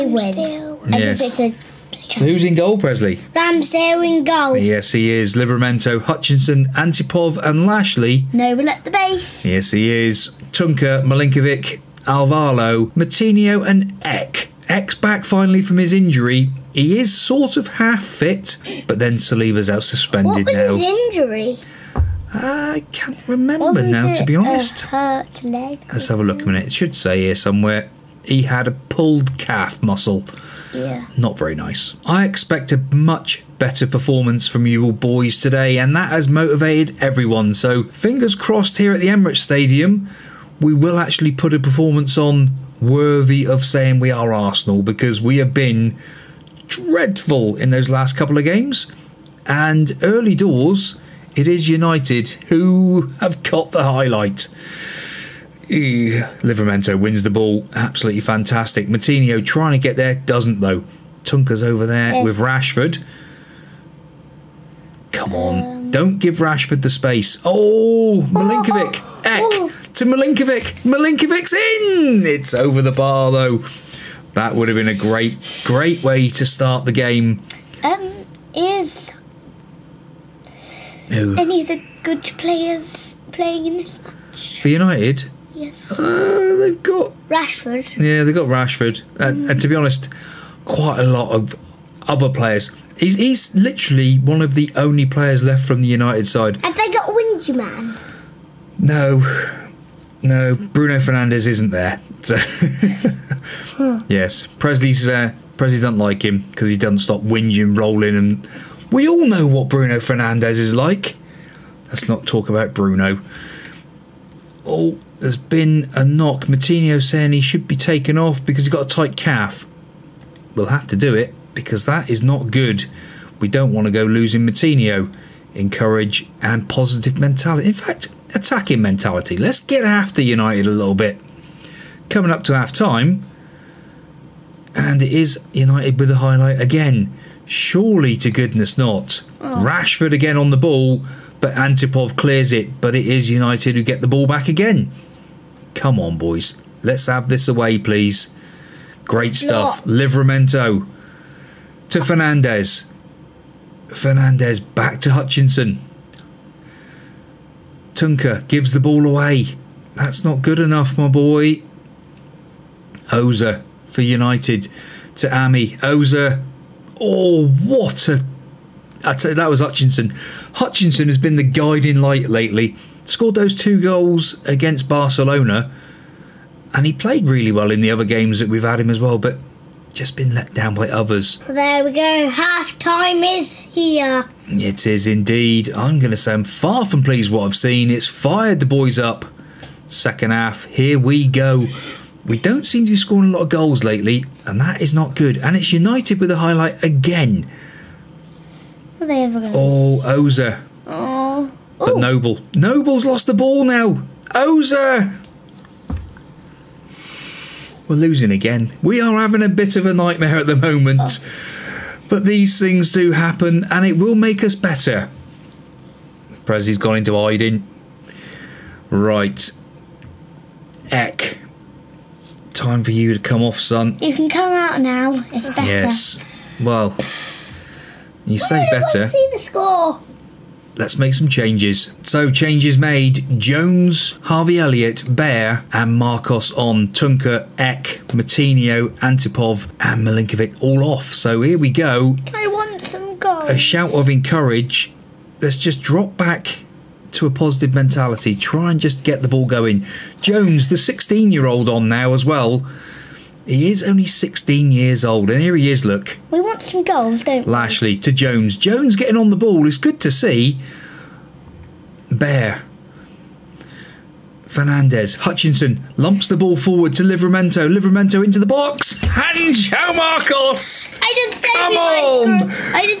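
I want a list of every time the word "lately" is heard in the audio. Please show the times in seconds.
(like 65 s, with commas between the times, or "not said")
172 s, 193 s.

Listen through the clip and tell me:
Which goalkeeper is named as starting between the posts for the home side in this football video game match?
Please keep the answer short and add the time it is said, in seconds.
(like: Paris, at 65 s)
Ramsdale, at 3 s.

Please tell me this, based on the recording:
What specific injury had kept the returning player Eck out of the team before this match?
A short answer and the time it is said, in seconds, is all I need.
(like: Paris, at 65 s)
Pulled calf muscle, at 28 s.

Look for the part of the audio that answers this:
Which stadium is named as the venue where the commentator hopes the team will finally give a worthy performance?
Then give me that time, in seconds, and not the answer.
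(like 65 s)
39 s.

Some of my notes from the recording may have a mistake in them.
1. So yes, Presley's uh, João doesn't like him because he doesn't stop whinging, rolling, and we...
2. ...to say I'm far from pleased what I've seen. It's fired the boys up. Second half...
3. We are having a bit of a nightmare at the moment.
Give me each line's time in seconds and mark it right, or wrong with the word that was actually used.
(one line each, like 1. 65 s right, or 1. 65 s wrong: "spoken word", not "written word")
1. 102 s wrong: "Presley", not "João"
2. 186 s right
3. 208 s right.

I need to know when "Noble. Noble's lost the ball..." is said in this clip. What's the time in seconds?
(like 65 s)
201 s.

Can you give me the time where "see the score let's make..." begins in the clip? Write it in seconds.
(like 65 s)
229 s.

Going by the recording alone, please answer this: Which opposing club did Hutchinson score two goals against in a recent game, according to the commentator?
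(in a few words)
Barcelona.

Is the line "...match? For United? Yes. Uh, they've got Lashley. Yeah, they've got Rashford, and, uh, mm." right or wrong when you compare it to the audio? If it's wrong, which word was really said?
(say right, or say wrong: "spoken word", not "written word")
wrong: "Rashford", not "Lashley".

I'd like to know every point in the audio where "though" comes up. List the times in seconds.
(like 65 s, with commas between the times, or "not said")
60 s, 73 s.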